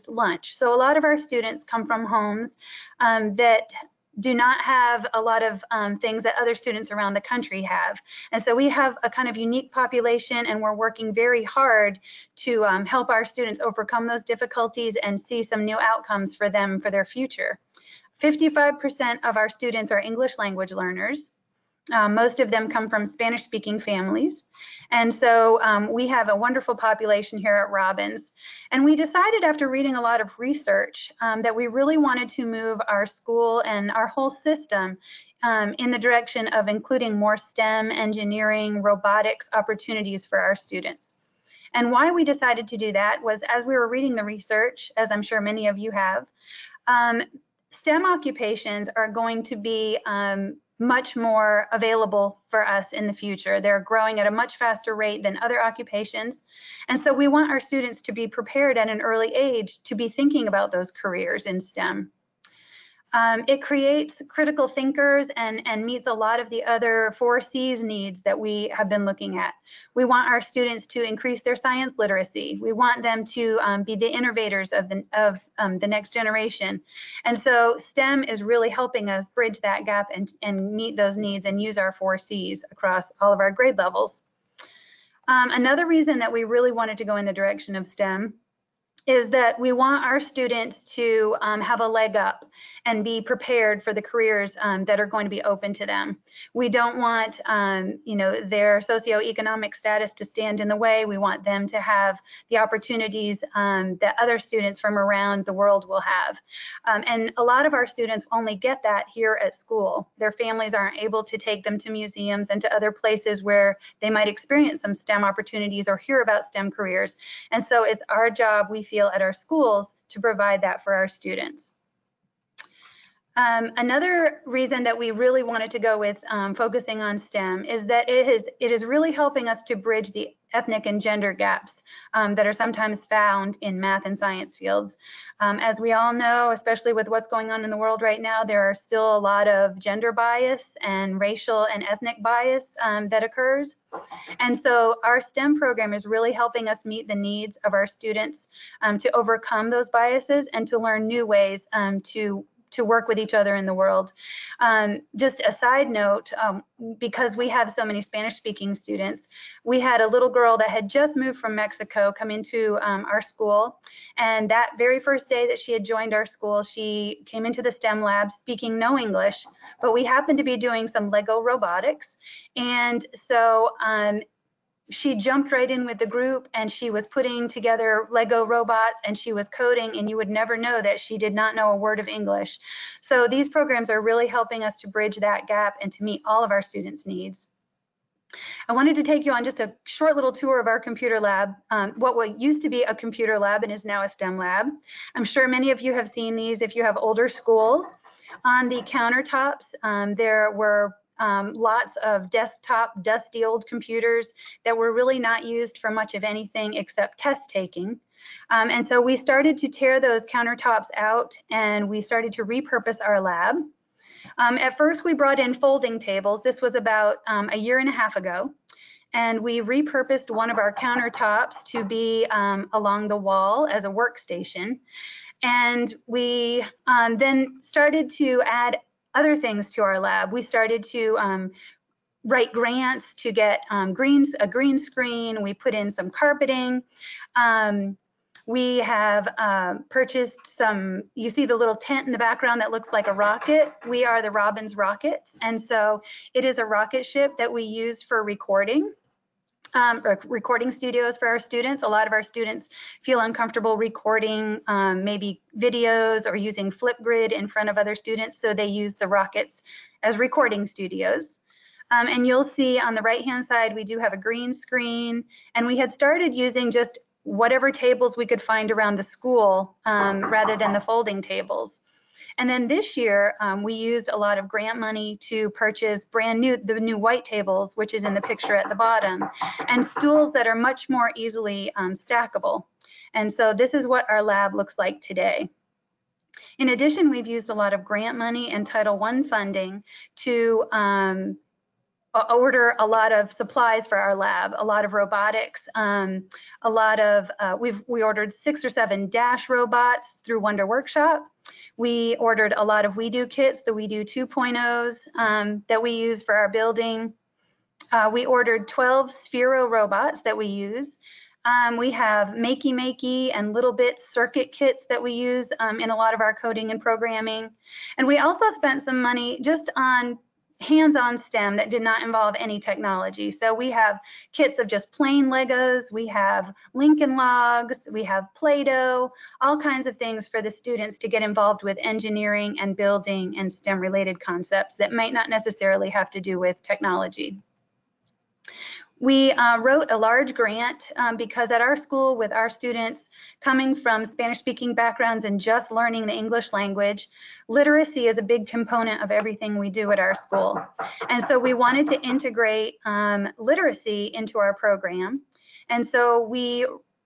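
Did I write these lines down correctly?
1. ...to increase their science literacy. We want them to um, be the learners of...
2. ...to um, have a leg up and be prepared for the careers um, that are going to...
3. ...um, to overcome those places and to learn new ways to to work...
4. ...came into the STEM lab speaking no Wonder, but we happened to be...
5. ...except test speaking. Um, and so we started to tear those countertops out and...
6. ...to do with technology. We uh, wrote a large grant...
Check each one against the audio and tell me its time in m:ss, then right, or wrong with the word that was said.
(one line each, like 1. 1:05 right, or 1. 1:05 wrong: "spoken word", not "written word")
1. 1:10 wrong: "innovators", not "learners"
2. 1:30 right
3. 2:28 wrong: "biases", not "places"
4. 2:47 wrong: "English", not "Wonder"
5. 3:26 wrong: "taking", not "speaking"
6. 5:36 right.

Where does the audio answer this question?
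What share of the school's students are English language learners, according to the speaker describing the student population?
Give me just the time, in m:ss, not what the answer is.
0:18.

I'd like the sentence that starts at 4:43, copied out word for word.
And so this is what our lab looks like today.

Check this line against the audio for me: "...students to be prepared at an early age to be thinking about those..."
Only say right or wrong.
right.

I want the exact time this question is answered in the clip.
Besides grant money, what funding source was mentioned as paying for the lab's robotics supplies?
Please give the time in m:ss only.
4:48.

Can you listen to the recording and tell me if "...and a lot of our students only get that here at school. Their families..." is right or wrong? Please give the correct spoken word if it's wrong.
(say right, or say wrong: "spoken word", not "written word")
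right.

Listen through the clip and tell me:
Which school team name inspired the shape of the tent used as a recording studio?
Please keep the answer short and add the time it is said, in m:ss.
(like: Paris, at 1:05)
Robbins Rockets, at 4:04.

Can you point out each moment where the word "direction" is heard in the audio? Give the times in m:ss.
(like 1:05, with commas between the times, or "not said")
0:35, 1:27.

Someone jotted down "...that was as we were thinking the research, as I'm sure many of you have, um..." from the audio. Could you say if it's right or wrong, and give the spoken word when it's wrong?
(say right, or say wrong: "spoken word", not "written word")
wrong: "reading", not "thinking".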